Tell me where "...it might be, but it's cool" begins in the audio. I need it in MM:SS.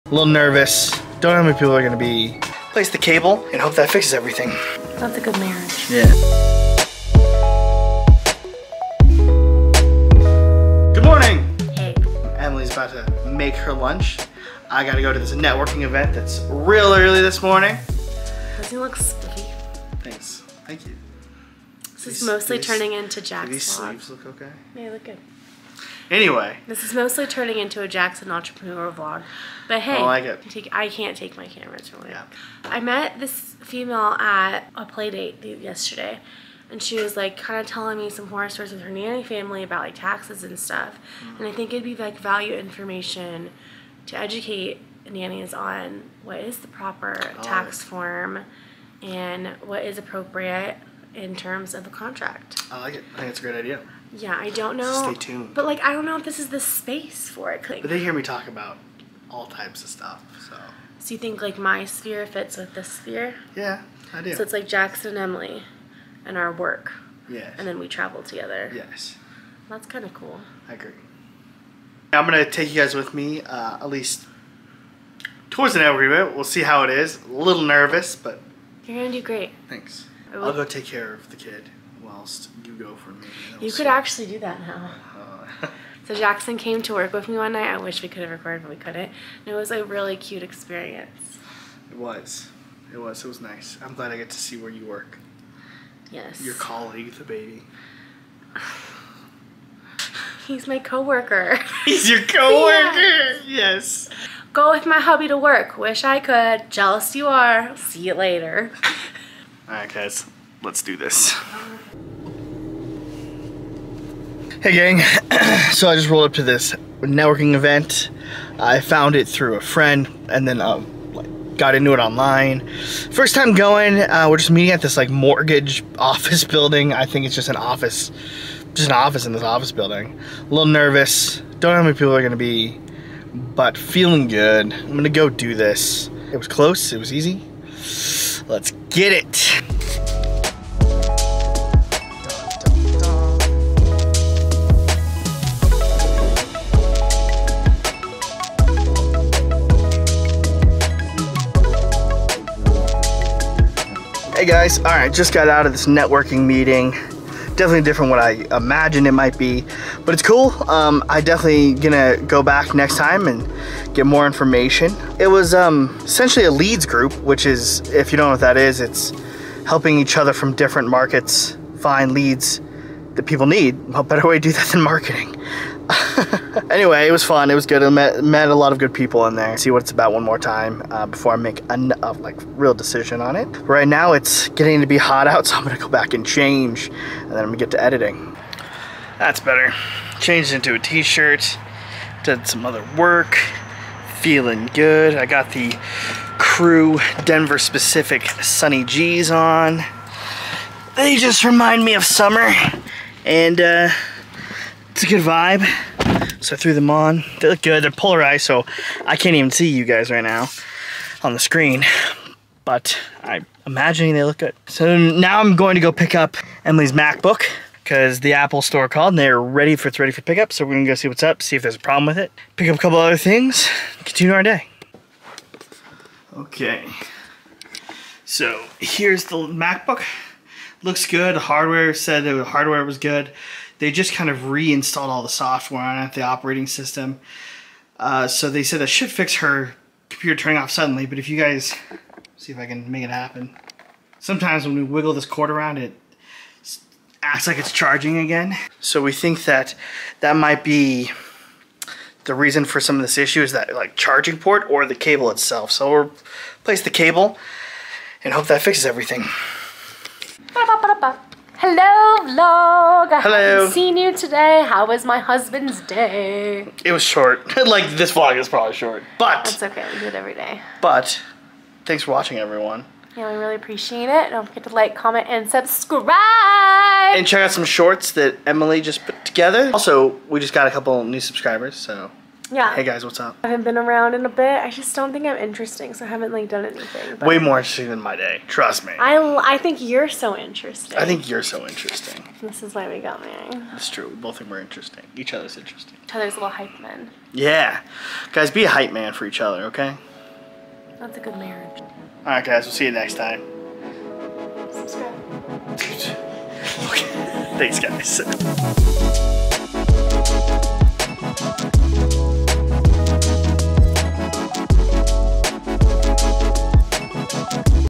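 02:39.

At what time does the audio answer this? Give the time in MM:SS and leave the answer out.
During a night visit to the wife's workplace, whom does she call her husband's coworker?
01:37.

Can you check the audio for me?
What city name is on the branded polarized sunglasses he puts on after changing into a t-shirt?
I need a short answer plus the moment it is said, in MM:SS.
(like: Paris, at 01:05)
Denver, at 03:17.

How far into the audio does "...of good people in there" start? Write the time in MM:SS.
02:58.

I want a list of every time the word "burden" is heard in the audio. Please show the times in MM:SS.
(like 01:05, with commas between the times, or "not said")
not said.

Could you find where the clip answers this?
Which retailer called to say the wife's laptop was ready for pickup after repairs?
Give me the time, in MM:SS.
03:38.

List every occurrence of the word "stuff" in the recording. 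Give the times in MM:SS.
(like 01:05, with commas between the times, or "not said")
00:40, 00:59.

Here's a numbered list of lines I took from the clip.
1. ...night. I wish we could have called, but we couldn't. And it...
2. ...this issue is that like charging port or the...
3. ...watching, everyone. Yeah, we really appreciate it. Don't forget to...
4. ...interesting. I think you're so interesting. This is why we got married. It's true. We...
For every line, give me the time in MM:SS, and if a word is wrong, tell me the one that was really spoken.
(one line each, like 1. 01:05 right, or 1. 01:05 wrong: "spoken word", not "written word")
1. 01:27 wrong: "recorded", not "called"
2. 04:13 right
3. 04:32 right
4. 04:50 right.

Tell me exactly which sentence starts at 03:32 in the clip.
But I'm imagining they look good.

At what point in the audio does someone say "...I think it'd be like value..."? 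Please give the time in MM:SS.
00:41.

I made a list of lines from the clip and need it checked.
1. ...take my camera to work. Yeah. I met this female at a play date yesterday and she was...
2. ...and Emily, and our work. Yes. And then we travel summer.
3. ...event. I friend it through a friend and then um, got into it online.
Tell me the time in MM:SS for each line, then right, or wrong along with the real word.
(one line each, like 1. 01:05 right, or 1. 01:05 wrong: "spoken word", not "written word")
1. 00:31 right
2. 01:05 wrong: "together", not "summer"
3. 01:57 wrong: "found", not "friend".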